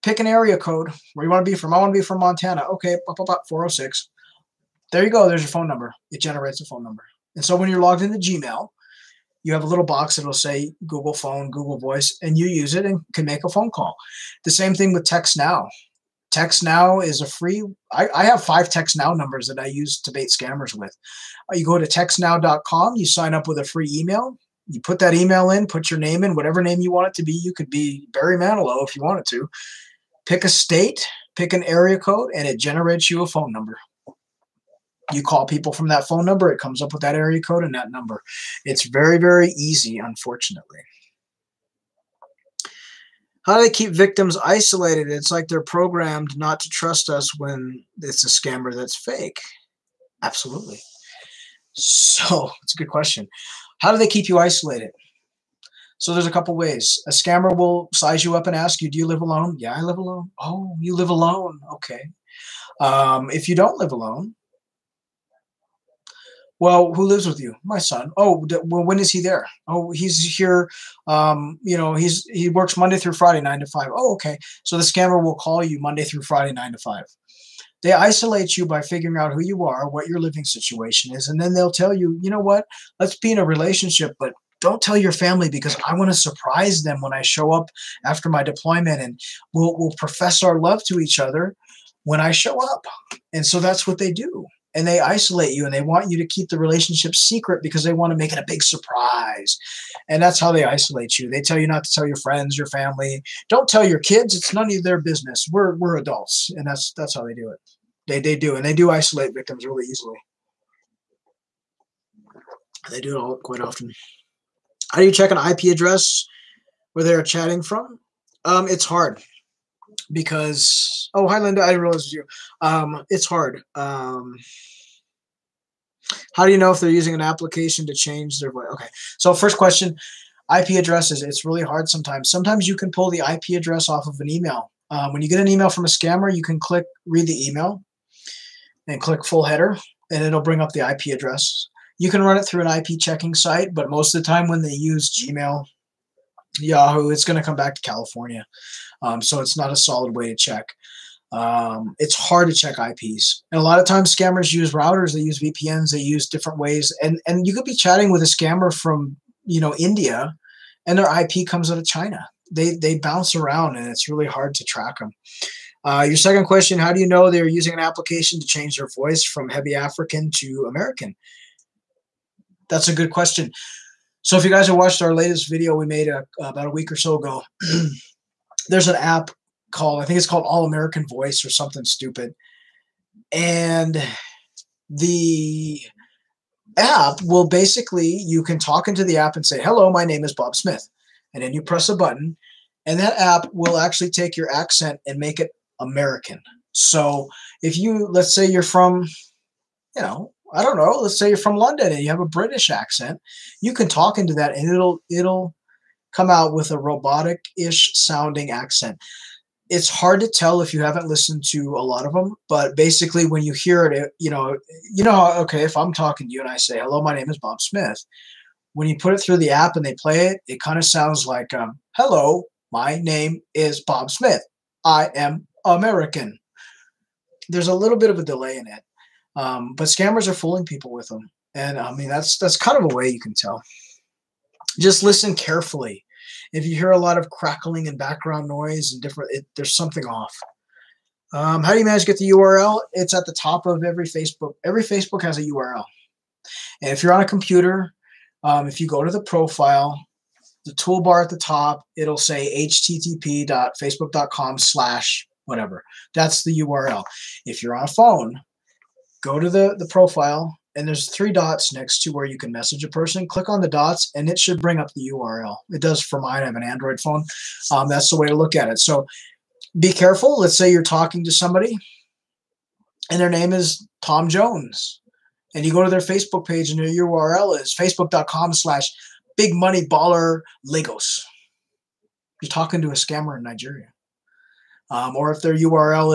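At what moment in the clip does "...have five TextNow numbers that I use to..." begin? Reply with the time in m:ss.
0:18.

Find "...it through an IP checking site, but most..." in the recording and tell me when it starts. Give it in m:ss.
2:22.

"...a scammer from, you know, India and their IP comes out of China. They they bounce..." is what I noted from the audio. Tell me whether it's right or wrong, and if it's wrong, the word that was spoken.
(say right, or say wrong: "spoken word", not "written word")
right.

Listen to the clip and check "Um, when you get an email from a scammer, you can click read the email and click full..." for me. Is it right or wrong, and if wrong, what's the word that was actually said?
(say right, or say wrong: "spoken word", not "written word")
right.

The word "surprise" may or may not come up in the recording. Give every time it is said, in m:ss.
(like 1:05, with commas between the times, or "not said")
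1:26, 1:38.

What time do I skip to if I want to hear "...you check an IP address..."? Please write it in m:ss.
1:55.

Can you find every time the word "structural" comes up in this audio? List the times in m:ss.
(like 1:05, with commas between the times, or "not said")
not said.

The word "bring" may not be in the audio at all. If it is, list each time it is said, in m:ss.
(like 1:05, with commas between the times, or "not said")
2:20, 4:24.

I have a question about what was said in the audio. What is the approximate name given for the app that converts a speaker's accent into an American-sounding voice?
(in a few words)
All American Voice.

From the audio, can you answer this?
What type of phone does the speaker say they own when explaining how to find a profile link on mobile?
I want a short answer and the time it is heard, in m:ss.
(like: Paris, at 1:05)
Android, at 4:26.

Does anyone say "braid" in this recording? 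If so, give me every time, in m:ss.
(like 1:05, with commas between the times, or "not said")
not said.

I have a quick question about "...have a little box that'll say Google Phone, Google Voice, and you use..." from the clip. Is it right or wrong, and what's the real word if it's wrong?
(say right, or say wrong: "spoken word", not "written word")
right.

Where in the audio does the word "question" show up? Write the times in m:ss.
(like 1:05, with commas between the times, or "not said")
0:52, 2:09, 2:46, 2:53.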